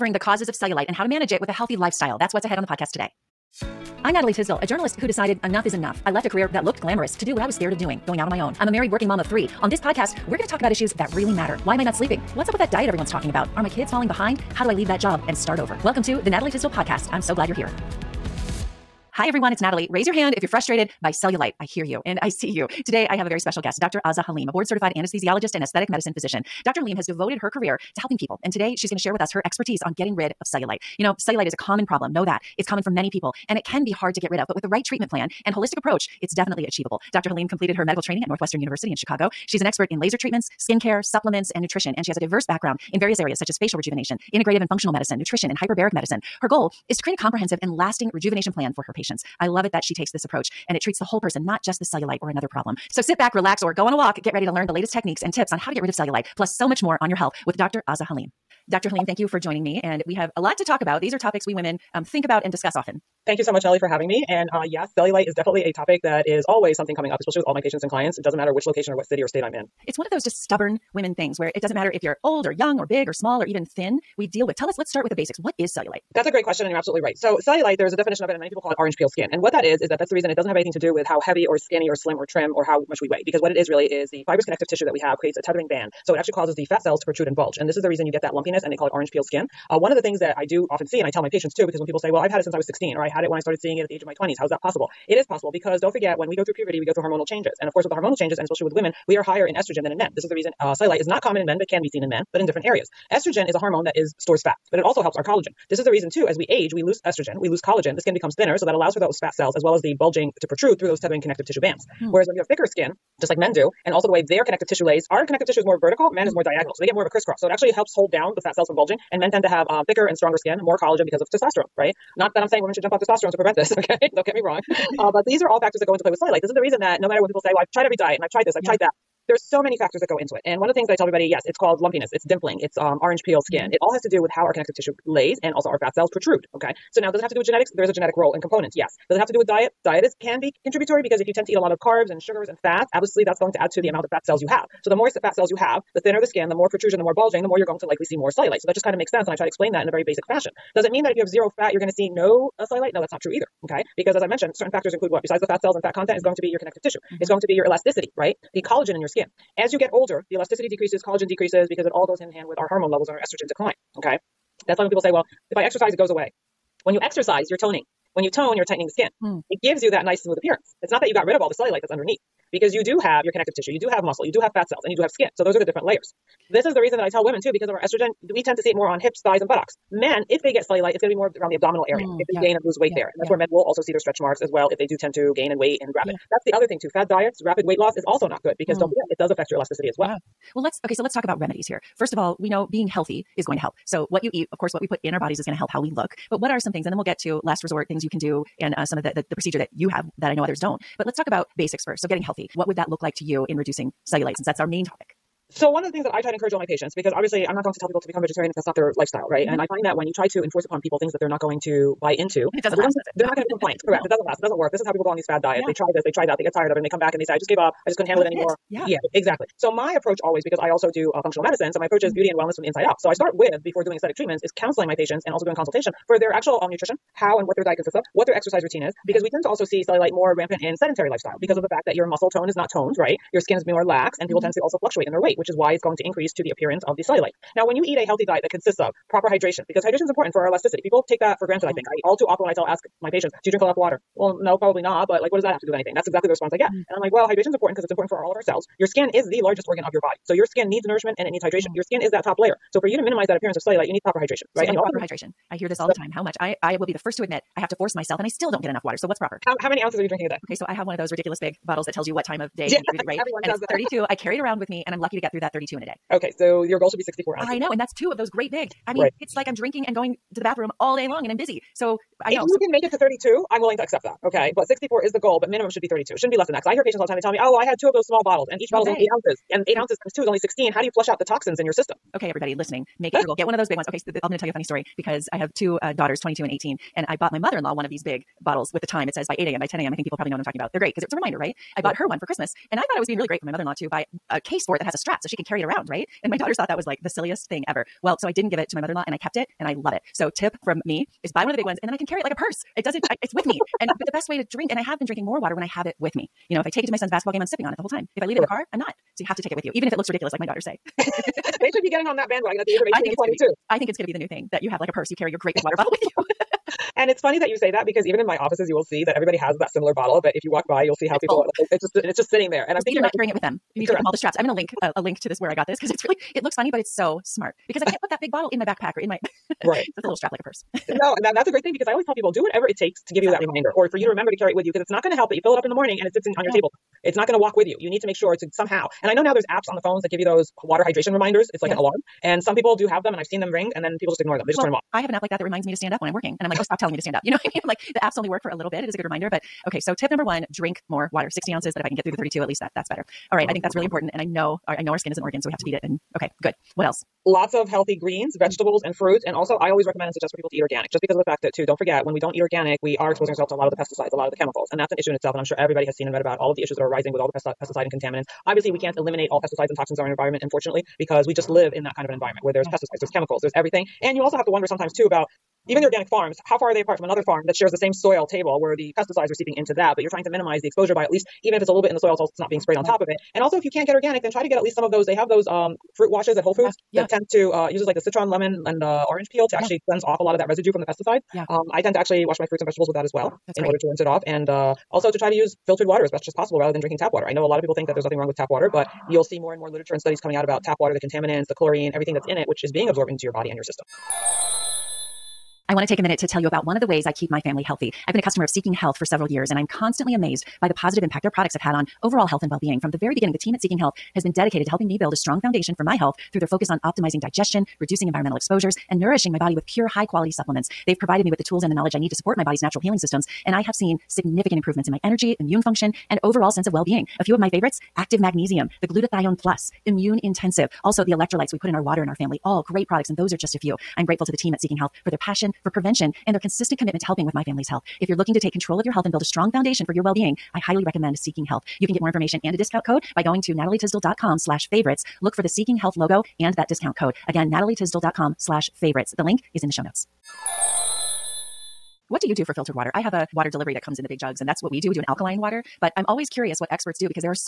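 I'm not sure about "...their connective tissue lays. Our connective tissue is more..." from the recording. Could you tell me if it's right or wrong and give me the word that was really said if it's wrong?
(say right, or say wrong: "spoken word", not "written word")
right.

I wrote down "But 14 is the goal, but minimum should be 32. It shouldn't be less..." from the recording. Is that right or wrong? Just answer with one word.
wrong.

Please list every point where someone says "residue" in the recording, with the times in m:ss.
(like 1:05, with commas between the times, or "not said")
6:30.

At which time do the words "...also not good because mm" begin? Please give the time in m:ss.
3:08.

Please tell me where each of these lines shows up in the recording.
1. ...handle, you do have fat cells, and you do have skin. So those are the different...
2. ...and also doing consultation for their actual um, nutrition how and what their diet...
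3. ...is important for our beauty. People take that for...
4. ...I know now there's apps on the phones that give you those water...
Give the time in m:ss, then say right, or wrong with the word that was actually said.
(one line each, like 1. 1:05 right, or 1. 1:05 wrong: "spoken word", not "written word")
1. 2:54 wrong: "muscle", not "handle"
2. 3:45 right
3. 4:00 wrong: "elasticity", not "beauty"
4. 5:39 right.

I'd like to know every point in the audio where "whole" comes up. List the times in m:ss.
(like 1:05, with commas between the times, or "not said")
0:51, 5:07, 6:26.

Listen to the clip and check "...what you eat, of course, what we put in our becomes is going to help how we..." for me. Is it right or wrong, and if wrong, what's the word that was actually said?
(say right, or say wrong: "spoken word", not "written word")
wrong: "bodies", not "becomes".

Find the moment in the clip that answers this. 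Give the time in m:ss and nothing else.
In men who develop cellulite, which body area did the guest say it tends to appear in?
3:01.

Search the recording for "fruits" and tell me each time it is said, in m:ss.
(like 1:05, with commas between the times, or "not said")
5:58, 6:25, 6:32.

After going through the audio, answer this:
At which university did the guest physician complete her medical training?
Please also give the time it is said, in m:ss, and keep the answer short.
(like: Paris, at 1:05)
Northwestern University, at 0:38.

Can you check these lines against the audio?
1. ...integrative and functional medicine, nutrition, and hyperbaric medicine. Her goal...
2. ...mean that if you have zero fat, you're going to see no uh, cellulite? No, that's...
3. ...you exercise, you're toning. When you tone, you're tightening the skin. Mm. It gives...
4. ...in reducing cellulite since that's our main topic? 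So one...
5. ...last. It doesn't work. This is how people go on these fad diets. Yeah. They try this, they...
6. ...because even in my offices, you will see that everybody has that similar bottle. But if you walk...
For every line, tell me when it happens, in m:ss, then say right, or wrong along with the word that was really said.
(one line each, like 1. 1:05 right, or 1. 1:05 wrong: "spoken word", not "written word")
1. 0:44 right
2. 2:30 right
3. 2:46 right
4. 3:23 right
5. 3:34 right
6. 5:17 right.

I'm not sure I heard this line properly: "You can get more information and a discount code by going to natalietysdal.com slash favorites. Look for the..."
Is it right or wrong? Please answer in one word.
right.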